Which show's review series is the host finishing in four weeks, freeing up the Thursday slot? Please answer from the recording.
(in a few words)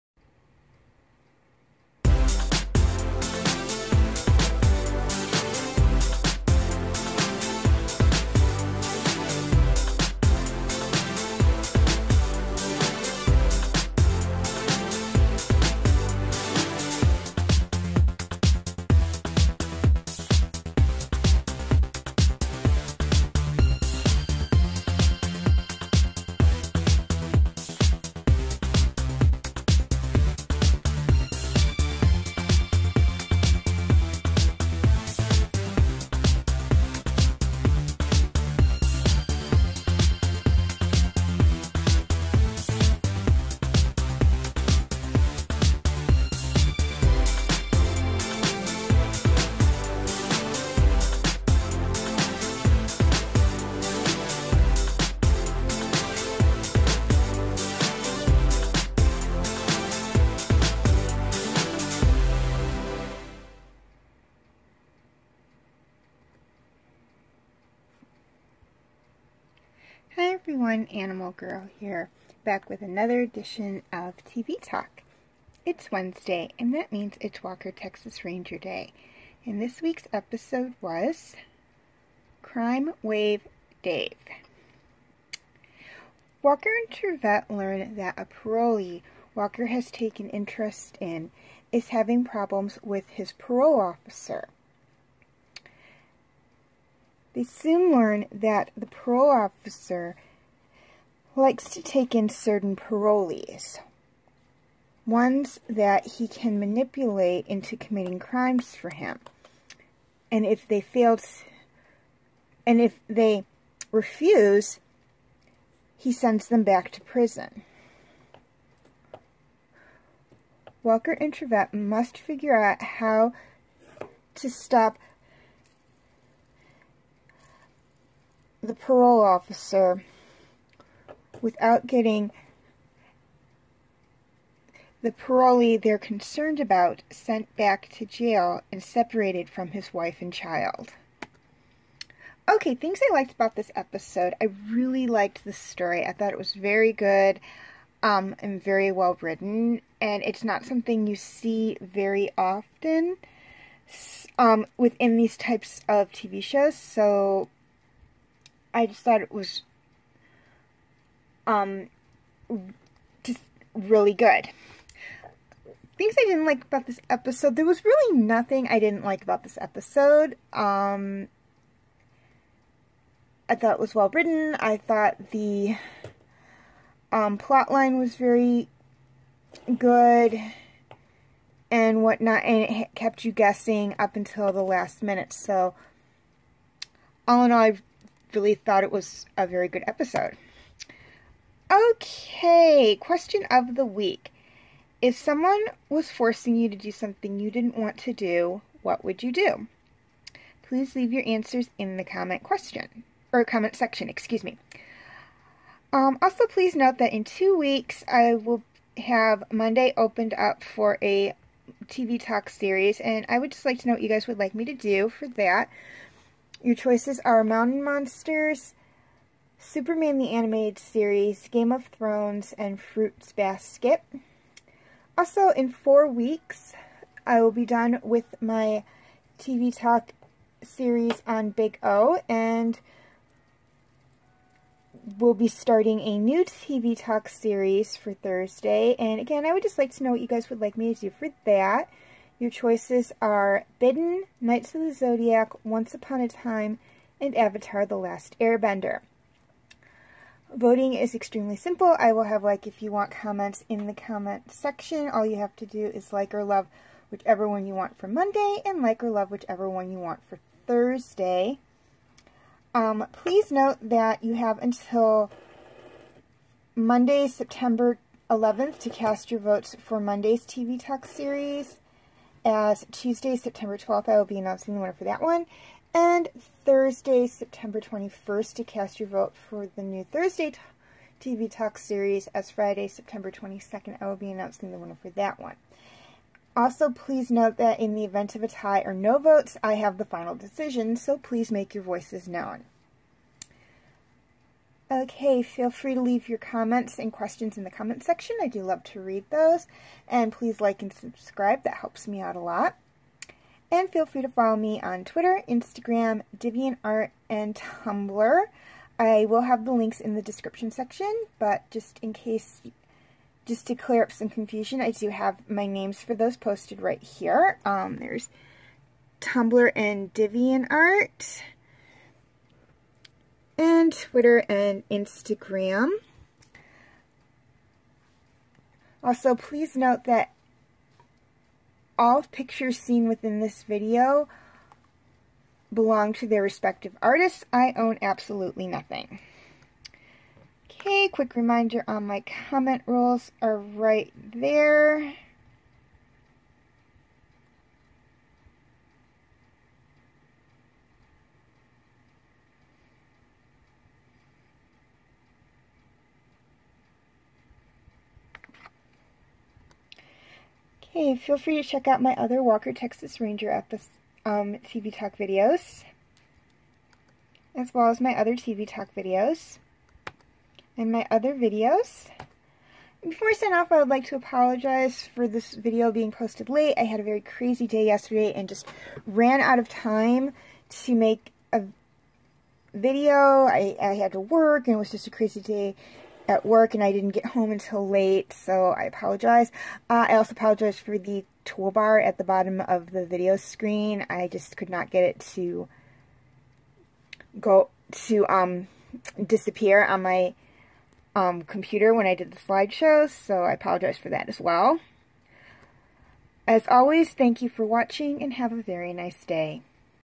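Big O.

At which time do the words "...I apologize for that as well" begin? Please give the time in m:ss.
6:43.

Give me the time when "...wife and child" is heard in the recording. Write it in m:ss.
2:19.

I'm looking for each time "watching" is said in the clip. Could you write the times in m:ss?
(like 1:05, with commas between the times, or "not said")
6:47.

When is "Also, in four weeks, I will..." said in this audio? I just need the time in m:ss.
3:45.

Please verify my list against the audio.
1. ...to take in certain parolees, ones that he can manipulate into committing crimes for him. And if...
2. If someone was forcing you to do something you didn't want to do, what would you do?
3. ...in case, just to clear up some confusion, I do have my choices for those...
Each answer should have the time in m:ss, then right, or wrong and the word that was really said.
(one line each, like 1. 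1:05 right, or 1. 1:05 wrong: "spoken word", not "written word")
1. 1:41 right
2. 3:15 right
3. 5:12 wrong: "names", not "choices".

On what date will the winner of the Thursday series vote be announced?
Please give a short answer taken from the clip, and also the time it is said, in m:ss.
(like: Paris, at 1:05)
Friday, September 22nd, at 4:42.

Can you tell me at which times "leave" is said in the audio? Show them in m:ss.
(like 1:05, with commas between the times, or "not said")
3:20, 4:56.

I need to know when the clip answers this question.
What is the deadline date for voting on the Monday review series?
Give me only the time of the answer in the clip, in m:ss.
4:26.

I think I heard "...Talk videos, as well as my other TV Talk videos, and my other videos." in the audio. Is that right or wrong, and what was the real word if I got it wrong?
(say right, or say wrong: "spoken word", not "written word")
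right.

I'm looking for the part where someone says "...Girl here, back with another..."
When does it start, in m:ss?
1:11.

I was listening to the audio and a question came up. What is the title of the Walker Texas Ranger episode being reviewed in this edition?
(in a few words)
Crime Wave Dave.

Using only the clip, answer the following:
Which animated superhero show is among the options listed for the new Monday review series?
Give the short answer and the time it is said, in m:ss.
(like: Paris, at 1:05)
Superman the Animated Series, at 3:39.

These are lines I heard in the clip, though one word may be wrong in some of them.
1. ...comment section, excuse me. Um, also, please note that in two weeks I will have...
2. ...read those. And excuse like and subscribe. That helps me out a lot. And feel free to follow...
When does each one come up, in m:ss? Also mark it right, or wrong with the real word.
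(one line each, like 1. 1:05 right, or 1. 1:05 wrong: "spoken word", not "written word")
1. 3:23 right
2. 4:59 wrong: "please", not "excuse".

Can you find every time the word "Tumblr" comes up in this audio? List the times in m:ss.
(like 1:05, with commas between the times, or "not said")
5:07, 5:19.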